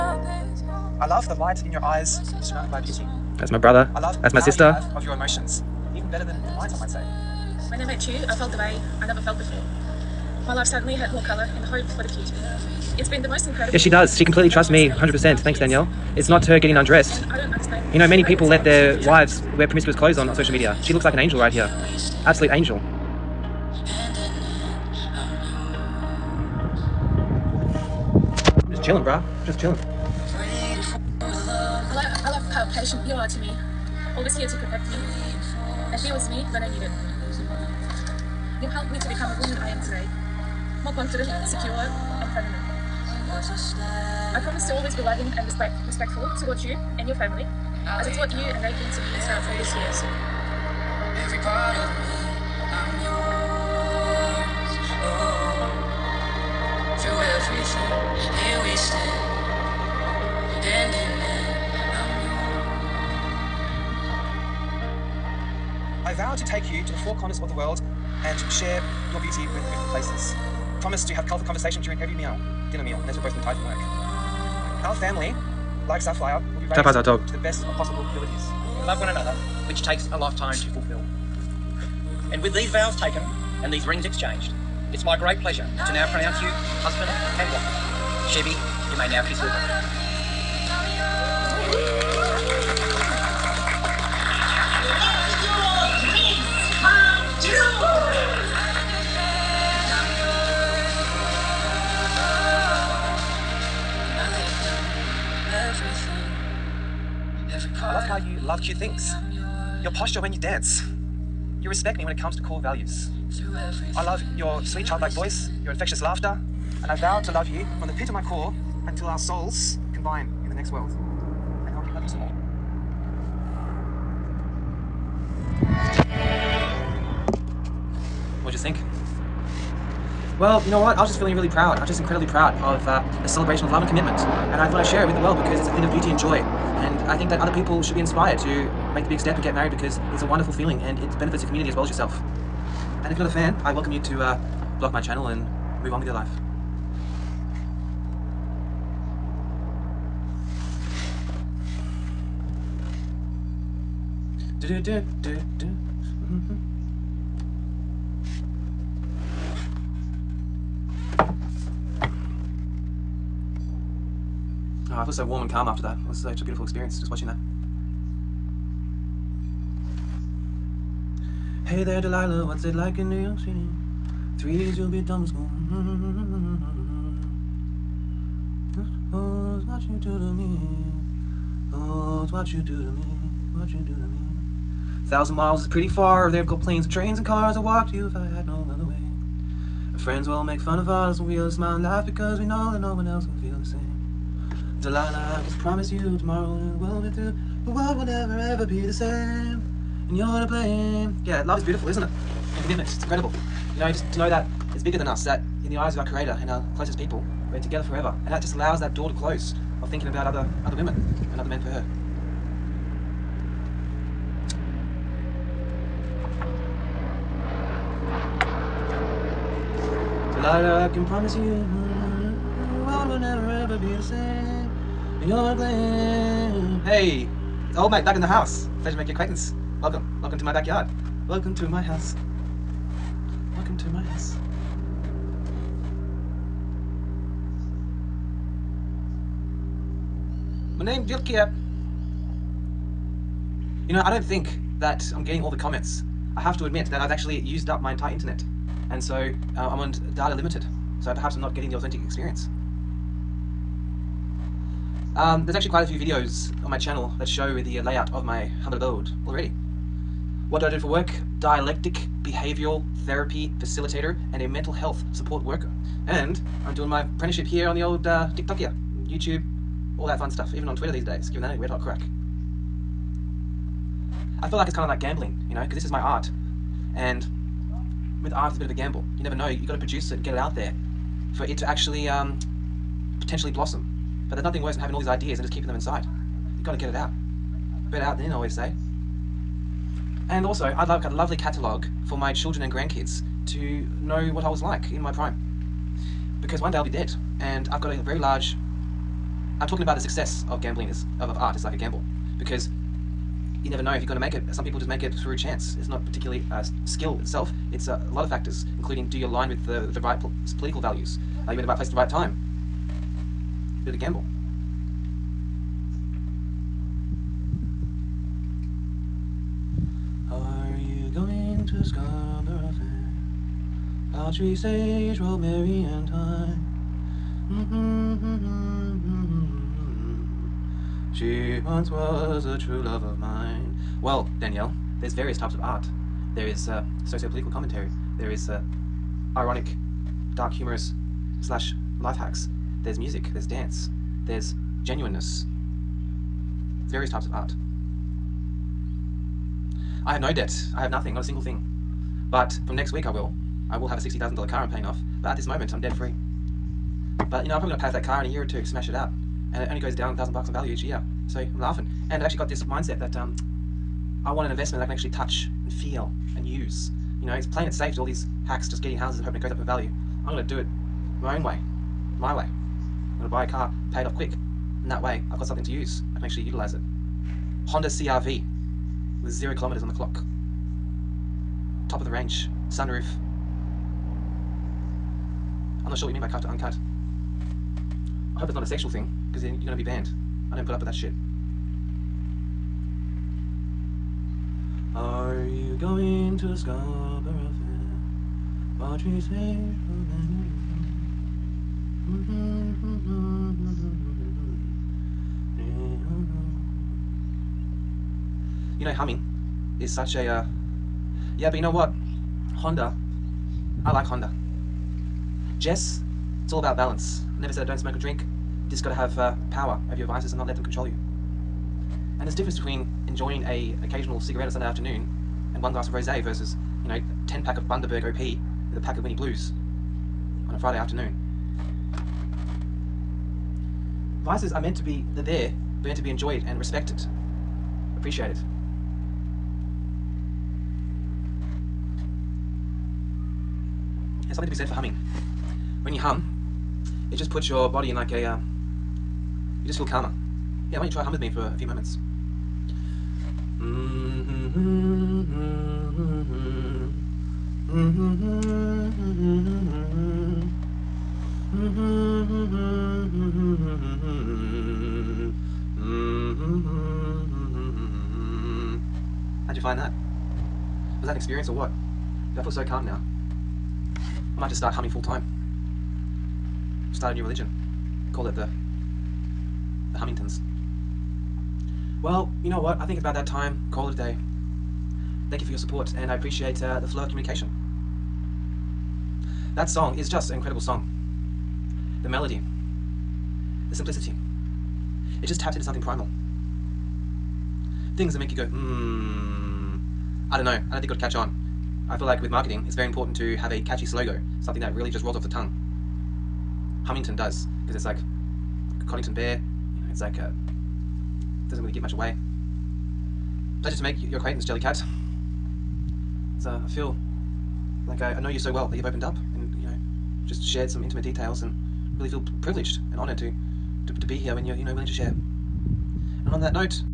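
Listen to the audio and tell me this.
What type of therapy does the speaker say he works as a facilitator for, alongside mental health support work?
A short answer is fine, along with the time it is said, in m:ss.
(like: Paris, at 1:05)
Dialectic behavioral therapy, at 4:21.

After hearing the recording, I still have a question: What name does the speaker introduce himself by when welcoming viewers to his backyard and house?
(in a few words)
Jill Kiep.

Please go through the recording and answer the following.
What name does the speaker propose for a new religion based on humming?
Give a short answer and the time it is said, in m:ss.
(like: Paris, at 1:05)
the Hummingtons, at 7:59.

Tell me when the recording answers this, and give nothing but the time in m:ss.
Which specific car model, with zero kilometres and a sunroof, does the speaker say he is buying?
6:17.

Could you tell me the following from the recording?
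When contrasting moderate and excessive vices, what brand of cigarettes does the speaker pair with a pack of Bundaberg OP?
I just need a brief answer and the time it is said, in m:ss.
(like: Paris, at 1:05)
Winnie Blues, at 7:09.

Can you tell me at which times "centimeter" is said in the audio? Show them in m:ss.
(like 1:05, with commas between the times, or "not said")
not said.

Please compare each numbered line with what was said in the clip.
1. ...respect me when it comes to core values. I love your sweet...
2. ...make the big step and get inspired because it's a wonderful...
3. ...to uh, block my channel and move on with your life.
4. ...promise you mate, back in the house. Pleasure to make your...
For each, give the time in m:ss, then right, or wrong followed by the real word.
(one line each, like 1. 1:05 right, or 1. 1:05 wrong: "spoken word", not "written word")
1. 1:51 right
2. 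2:18 wrong: "married", not "inspired"
3. 2:24 right
4. 3:41 right.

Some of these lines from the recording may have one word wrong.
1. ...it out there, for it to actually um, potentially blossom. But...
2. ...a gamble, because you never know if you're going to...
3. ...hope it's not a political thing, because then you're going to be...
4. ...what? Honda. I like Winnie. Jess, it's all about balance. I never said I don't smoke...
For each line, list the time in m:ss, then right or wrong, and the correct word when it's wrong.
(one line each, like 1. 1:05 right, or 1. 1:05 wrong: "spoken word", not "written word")
1. 4:40 right
2. 5:01 right
3. 6:28 wrong: "sexual", not "political"
4. 6:51 wrong: "Honda", not "Winnie".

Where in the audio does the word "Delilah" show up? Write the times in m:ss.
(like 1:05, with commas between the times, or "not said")
2:52, 3:14.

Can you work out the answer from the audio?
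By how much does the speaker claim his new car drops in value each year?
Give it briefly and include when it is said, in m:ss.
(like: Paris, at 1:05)
1,000 dollars, at 6:00.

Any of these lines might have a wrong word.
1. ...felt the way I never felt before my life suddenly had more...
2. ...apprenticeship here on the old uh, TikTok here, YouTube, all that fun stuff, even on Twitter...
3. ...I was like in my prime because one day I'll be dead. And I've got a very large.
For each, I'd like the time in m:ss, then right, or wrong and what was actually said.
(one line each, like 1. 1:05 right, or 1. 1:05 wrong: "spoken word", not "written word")
1. 0:08 right
2. 4:27 right
3. 4:54 right.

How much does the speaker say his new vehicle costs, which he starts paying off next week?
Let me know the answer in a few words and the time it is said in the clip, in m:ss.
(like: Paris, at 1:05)
$60,000, at 5:53.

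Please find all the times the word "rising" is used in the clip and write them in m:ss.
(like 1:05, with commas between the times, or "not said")
not said.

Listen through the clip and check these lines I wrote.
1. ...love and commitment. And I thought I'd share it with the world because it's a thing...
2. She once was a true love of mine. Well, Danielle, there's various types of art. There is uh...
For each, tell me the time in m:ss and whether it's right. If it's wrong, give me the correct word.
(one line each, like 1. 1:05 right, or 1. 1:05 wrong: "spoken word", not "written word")
1. 2:13 right
2. 5:31 right.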